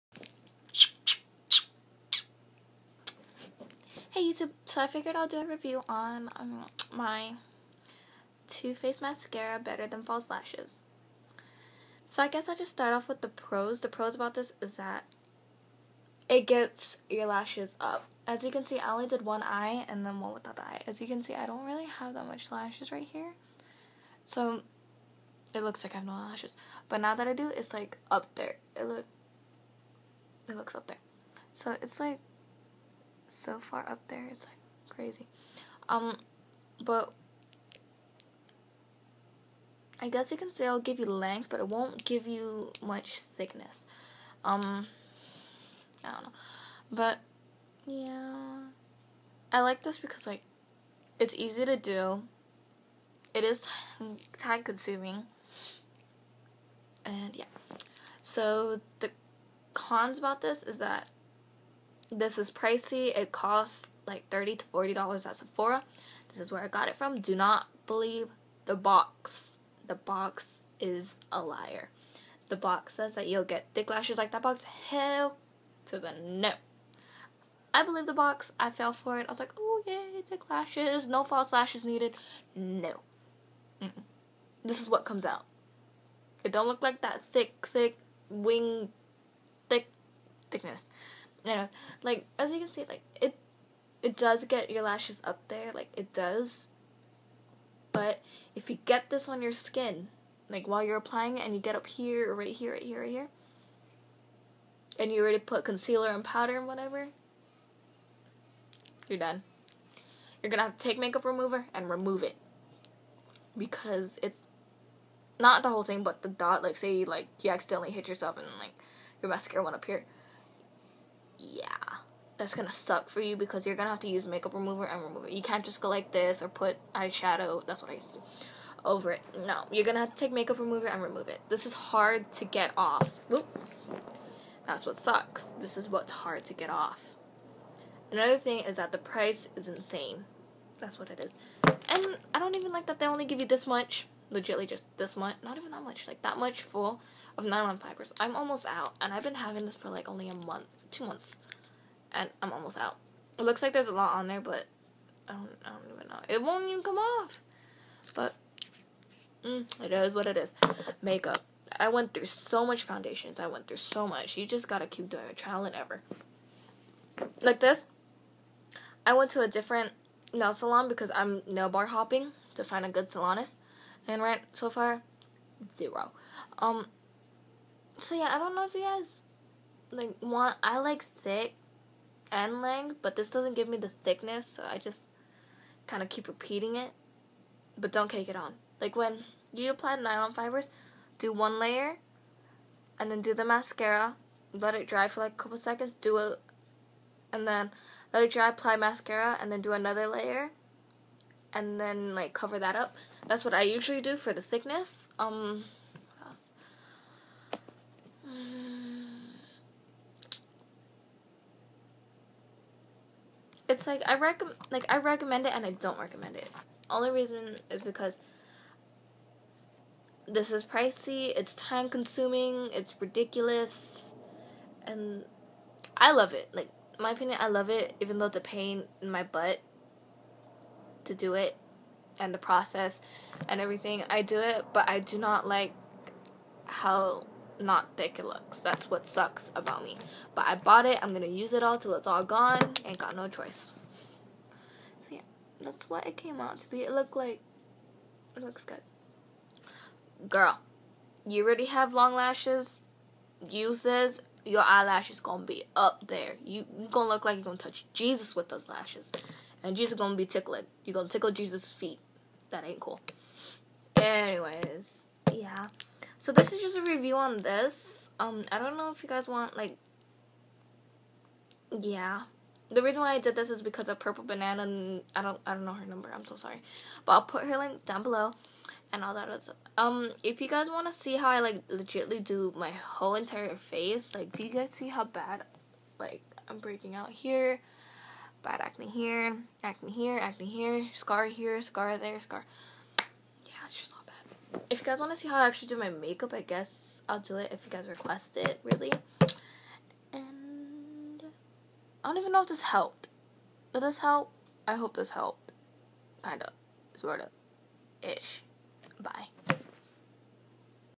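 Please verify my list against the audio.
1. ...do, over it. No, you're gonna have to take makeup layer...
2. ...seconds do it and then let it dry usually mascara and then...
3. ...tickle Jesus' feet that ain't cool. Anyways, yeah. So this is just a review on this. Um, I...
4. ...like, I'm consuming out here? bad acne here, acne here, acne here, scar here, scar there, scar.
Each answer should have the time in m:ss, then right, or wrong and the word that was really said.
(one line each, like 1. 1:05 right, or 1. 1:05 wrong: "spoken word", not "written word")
1. 2:08 wrong: "remover", not "layer"
2. 3:15 wrong: "apply", not "usually"
3. 4:21 right
4. 4:45 wrong: "breaking", not "consuming".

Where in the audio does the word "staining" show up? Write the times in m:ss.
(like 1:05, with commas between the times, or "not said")
not said.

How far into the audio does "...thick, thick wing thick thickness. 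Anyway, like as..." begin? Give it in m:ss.
1:27.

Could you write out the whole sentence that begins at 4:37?
But I'll put her link down below, and all that.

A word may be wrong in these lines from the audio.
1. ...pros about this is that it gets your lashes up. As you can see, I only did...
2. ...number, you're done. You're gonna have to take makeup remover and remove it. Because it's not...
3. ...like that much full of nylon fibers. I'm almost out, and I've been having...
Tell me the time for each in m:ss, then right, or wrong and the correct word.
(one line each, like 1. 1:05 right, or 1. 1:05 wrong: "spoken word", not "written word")
1. 0:13 right
2. 1:46 wrong: "whatever", not "number"
3. 2:26 right.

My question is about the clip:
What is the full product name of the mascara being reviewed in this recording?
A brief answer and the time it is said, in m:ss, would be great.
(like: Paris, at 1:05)
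Better Than False Lashes, at 0:09.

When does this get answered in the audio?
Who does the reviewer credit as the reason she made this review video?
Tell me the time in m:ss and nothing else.
4:33.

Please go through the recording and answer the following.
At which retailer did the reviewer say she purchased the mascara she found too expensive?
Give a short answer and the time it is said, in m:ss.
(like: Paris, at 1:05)
Sephora, at 1:05.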